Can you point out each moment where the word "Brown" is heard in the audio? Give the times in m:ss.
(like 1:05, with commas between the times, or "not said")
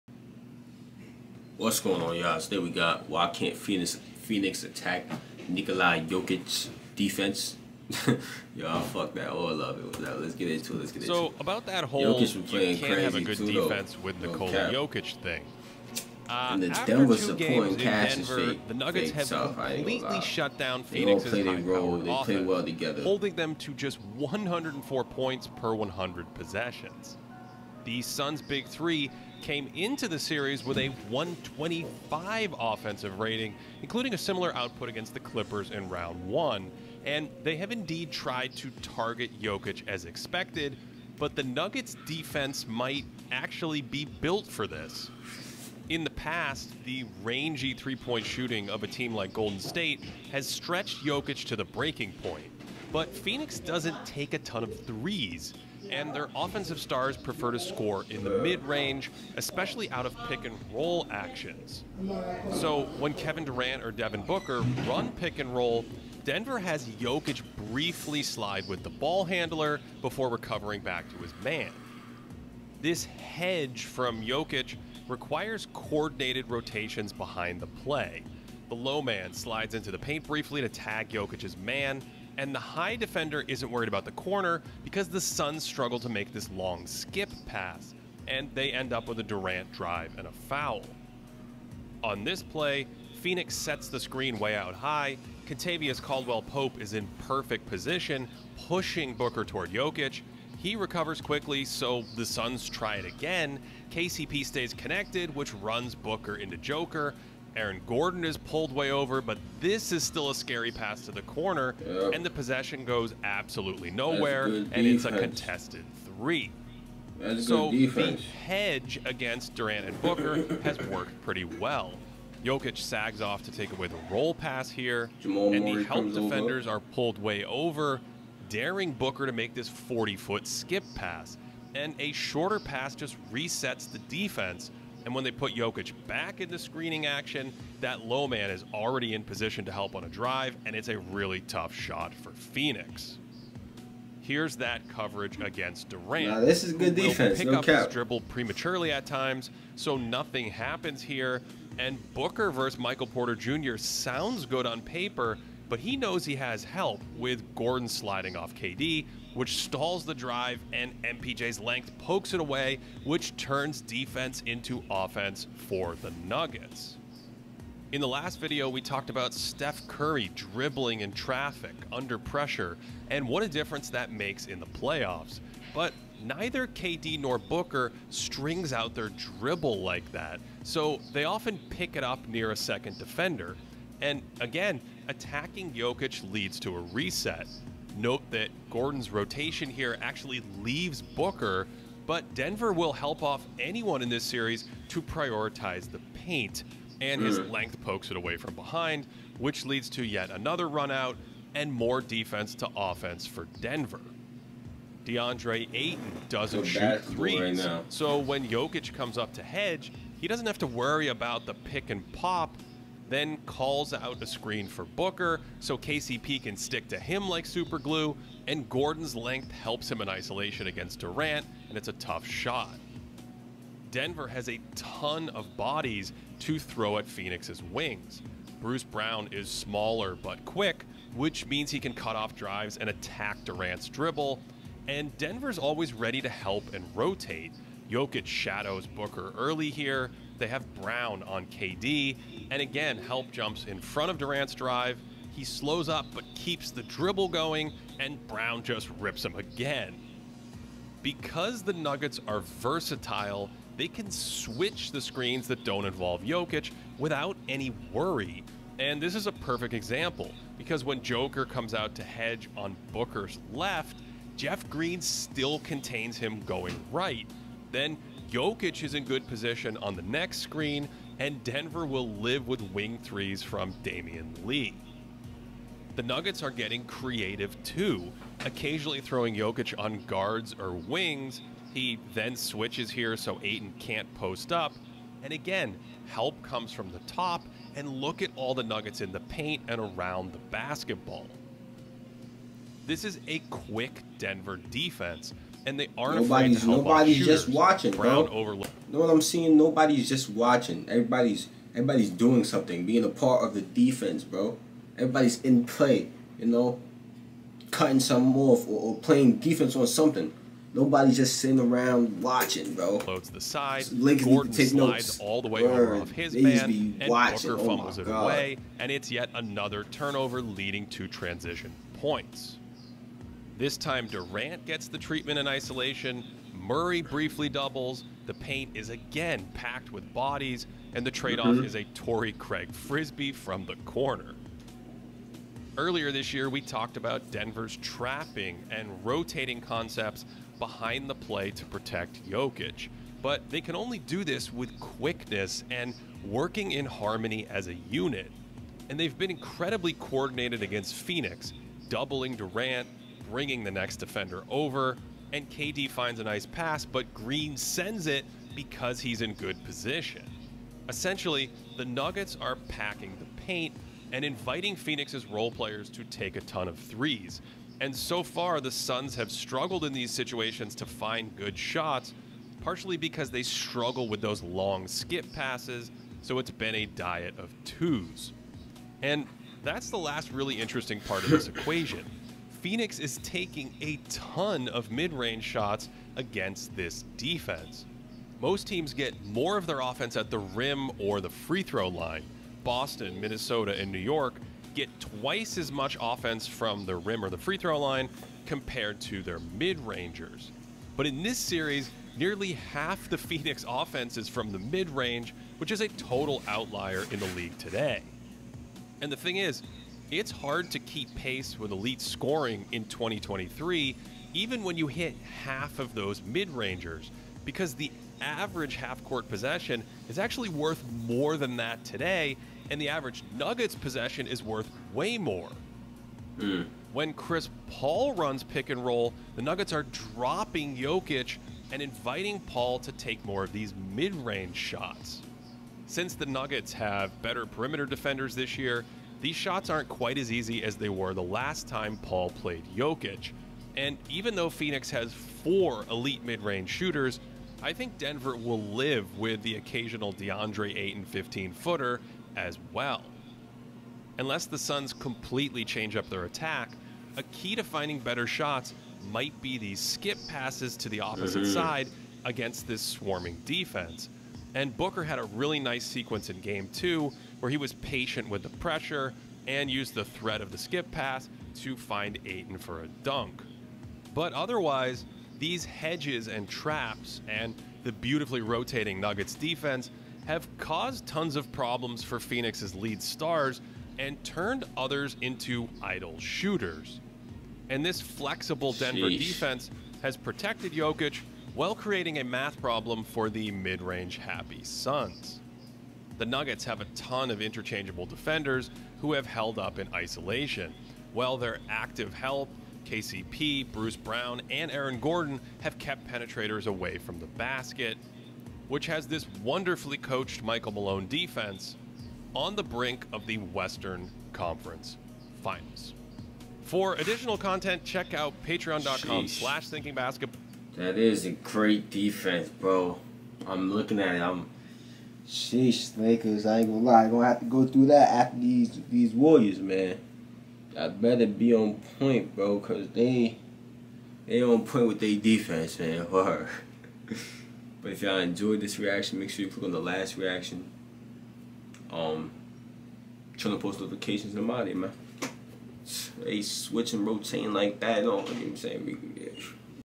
3:48, 4:00, 4:08, 4:57, 8:23.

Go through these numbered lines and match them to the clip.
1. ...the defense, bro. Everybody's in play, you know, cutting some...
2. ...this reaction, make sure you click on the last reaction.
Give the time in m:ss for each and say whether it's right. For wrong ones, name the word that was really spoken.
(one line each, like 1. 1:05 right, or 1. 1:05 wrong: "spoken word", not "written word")
1. 5:03 right
2. 8:58 right.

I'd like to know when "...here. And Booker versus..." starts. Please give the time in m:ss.
2:31.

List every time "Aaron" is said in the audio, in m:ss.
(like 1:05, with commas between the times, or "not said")
1:47, 8:24.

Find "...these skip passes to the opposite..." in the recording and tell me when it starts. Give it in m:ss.
7:39.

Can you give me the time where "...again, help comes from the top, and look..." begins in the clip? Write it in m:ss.
4:45.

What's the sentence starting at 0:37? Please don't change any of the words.
And they have indeed tried to target Jokic as expected, but the Nuggets' defense might actually be built for this.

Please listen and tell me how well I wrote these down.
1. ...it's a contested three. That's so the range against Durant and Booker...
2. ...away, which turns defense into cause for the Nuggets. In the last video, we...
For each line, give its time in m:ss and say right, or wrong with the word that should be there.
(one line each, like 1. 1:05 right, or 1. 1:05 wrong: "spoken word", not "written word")
1. 1:54 wrong: "hedge", not "range"
2. 2:42 wrong: "offense", not "cause".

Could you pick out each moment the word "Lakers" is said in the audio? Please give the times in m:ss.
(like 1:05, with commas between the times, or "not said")
8:45.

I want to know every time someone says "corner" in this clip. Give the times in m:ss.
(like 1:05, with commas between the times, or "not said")
1:24, 1:51, 5:33.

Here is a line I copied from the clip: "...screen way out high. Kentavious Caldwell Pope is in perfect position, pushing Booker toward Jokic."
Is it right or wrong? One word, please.
right.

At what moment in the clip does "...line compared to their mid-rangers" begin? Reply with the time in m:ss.
6:37.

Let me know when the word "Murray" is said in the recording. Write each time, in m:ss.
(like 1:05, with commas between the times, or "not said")
2:05, 5:26.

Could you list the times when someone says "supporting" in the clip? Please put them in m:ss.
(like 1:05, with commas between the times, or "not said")
0:17.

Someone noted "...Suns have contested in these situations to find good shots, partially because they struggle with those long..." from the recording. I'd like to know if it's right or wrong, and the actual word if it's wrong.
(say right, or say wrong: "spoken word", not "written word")
wrong: "struggled", not "contested".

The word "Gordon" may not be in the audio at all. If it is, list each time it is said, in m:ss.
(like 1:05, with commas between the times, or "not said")
1:47, 2:37, 3:08, 3:38, 5:14, 8:24.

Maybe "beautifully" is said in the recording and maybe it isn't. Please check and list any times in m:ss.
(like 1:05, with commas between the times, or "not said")
7:57.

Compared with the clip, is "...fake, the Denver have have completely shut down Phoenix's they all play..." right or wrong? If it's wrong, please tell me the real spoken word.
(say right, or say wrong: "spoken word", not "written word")
wrong: "Nuggets", not "Denver".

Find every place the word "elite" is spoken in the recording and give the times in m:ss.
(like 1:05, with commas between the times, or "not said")
6:51, 7:25.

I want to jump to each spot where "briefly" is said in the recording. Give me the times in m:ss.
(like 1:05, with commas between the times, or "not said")
1:07, 1:20, 5:27.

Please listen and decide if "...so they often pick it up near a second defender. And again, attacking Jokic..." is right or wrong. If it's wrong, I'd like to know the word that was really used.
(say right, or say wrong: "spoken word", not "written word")
right.